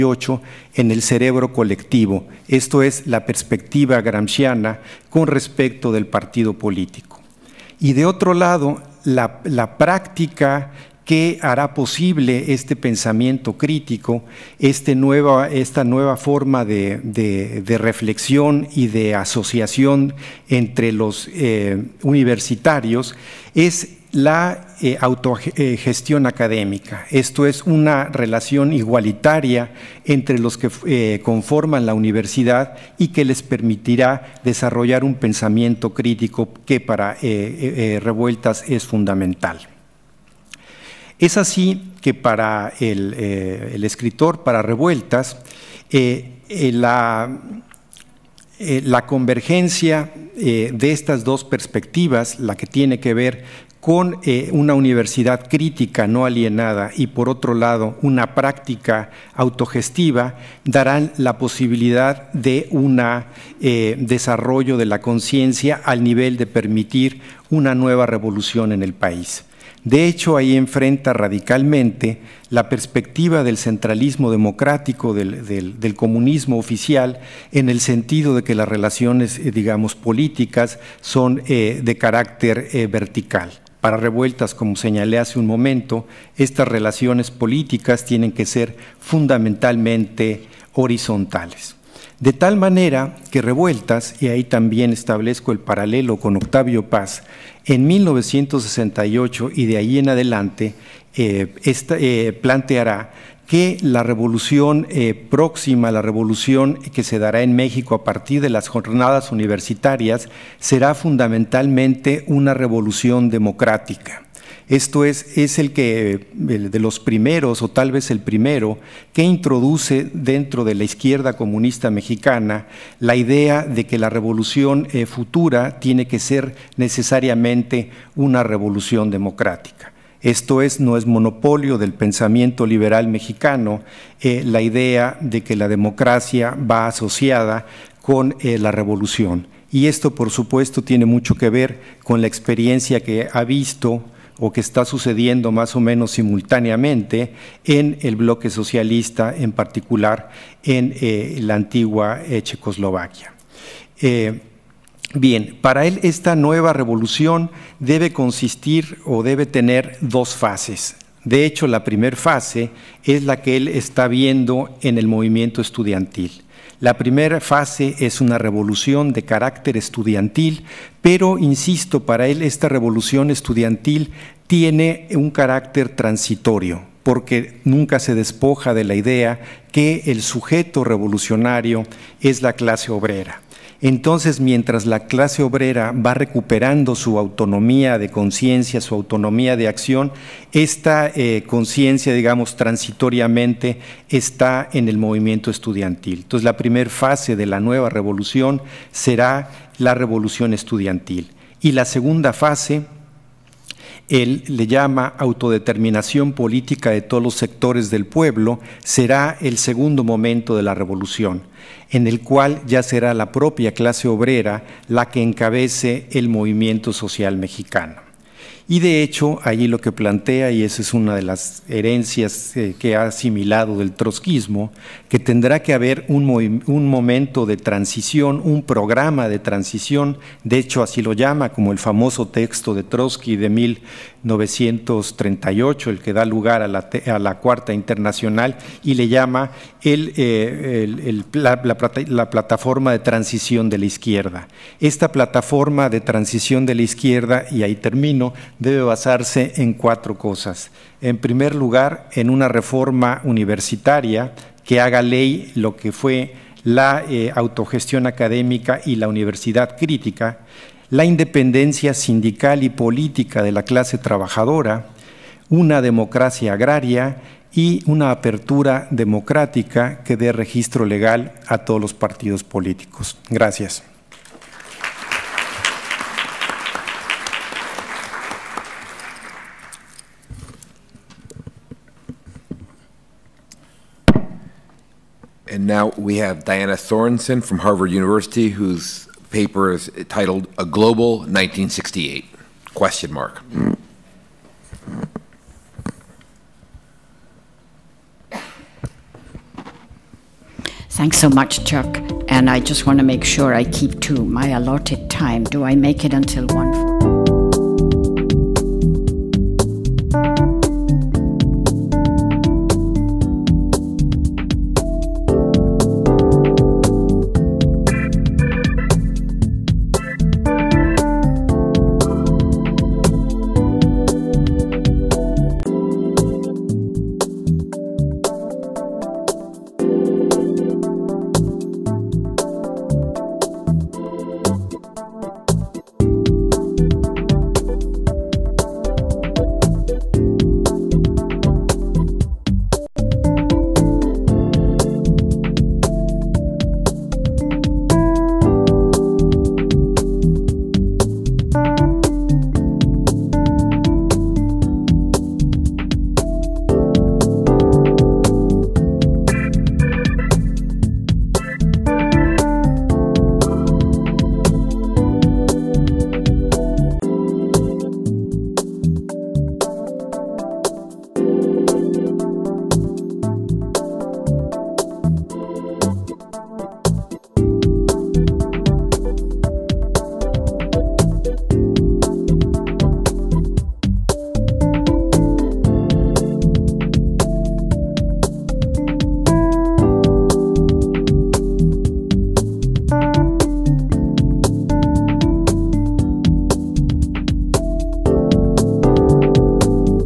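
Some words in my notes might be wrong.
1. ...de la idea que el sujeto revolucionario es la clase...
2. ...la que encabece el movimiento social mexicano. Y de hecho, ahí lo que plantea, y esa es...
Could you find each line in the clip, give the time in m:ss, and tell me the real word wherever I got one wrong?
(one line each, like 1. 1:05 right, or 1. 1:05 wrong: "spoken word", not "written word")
1. 2:58 right
2. 3:34 right.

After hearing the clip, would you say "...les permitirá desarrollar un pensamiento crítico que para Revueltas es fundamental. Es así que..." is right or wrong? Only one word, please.
right.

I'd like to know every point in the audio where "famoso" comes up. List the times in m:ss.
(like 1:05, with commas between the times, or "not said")
3:51.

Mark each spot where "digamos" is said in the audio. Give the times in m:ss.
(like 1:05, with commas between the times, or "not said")
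1:19, 3:12.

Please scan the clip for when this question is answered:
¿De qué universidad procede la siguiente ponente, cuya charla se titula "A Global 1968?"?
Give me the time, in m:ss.
4:47.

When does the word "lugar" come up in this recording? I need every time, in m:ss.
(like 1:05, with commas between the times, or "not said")
3:56, 4:11.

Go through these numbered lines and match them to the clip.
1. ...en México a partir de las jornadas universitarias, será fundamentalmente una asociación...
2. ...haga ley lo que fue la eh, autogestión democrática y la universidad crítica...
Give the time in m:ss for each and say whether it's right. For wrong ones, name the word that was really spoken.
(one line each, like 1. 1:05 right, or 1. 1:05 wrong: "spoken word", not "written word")
1. 1:47 wrong: "revolución", not "asociación"
2. 4:14 wrong: "académica", not "democrática".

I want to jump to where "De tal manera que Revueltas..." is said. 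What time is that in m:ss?
1:32.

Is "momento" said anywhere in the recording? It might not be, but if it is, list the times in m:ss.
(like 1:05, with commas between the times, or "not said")
1:25, 3:30, 3:46.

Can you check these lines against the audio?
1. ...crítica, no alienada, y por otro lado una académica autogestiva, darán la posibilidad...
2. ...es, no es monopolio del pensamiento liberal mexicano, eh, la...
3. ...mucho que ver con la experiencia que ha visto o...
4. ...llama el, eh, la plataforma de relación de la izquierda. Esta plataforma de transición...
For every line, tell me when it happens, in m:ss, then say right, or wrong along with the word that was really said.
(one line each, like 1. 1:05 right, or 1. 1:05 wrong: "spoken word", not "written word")
1. 0:55 wrong: "práctica", not "académica"
2. 2:10 right
3. 2:21 right
4. 3:59 wrong: "transición", not "relación".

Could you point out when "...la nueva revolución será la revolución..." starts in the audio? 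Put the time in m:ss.
3:17.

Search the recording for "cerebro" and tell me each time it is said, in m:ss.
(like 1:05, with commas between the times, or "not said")
0:01.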